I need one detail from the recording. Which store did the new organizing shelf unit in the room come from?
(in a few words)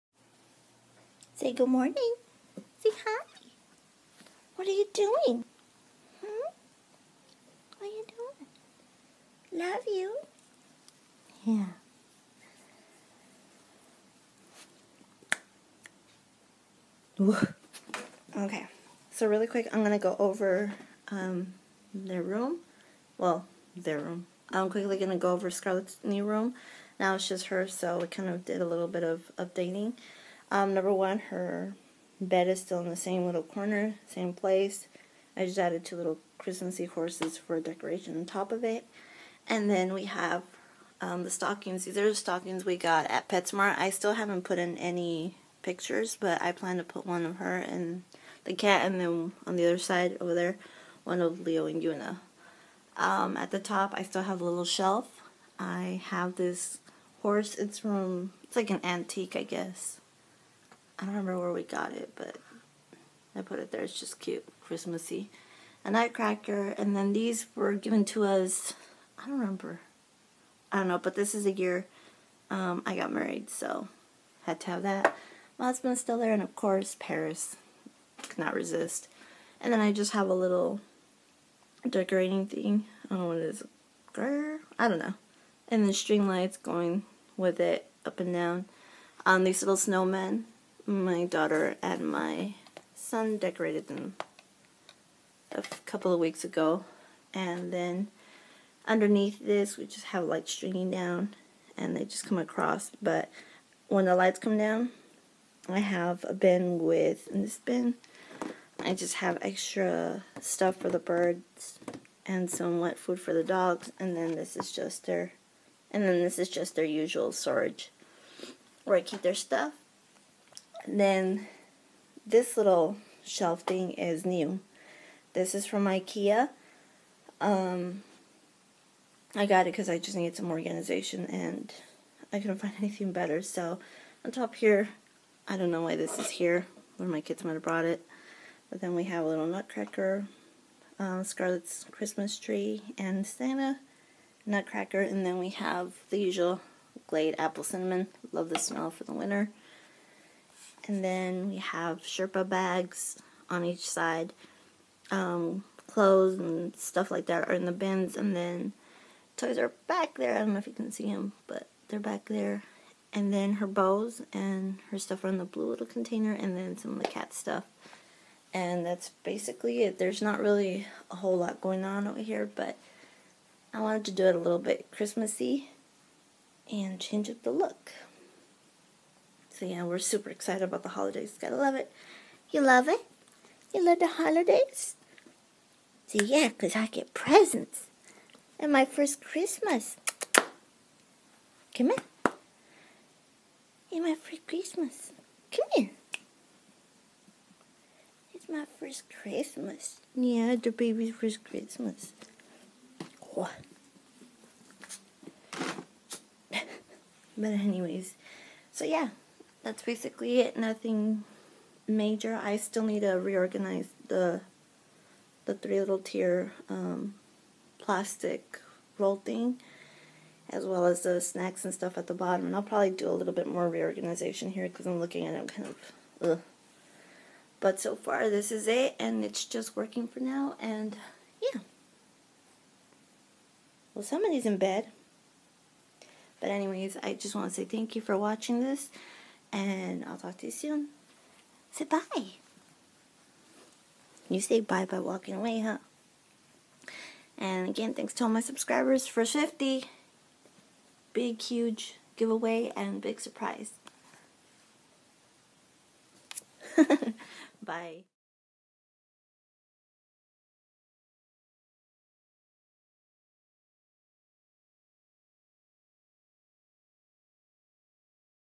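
Ikea.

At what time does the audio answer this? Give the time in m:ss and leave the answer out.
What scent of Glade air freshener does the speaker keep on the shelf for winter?
2:27.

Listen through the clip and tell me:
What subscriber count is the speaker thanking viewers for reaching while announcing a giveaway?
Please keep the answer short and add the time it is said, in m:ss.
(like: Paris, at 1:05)
50, at 4:09.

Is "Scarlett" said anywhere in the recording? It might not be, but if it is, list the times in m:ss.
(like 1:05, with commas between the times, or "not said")
0:25, 2:21.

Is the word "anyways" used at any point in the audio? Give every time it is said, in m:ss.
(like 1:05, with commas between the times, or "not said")
3:27, 3:56.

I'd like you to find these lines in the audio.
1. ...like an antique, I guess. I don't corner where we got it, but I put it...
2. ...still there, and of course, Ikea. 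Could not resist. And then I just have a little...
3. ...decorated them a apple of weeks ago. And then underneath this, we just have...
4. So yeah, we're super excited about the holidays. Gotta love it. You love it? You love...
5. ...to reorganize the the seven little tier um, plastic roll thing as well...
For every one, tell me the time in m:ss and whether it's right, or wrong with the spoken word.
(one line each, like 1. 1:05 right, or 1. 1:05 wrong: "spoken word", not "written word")
1. 0:58 wrong: "remember", not "corner"
2. 1:16 wrong: "Paris", not "Ikea"
3. 1:33 wrong: "couple", not "apple"
4. 2:59 right
5. 3:33 wrong: "three", not "seven".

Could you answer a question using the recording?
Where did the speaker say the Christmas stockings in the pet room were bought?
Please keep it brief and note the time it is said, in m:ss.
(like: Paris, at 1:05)
PetSmart, at 0:43.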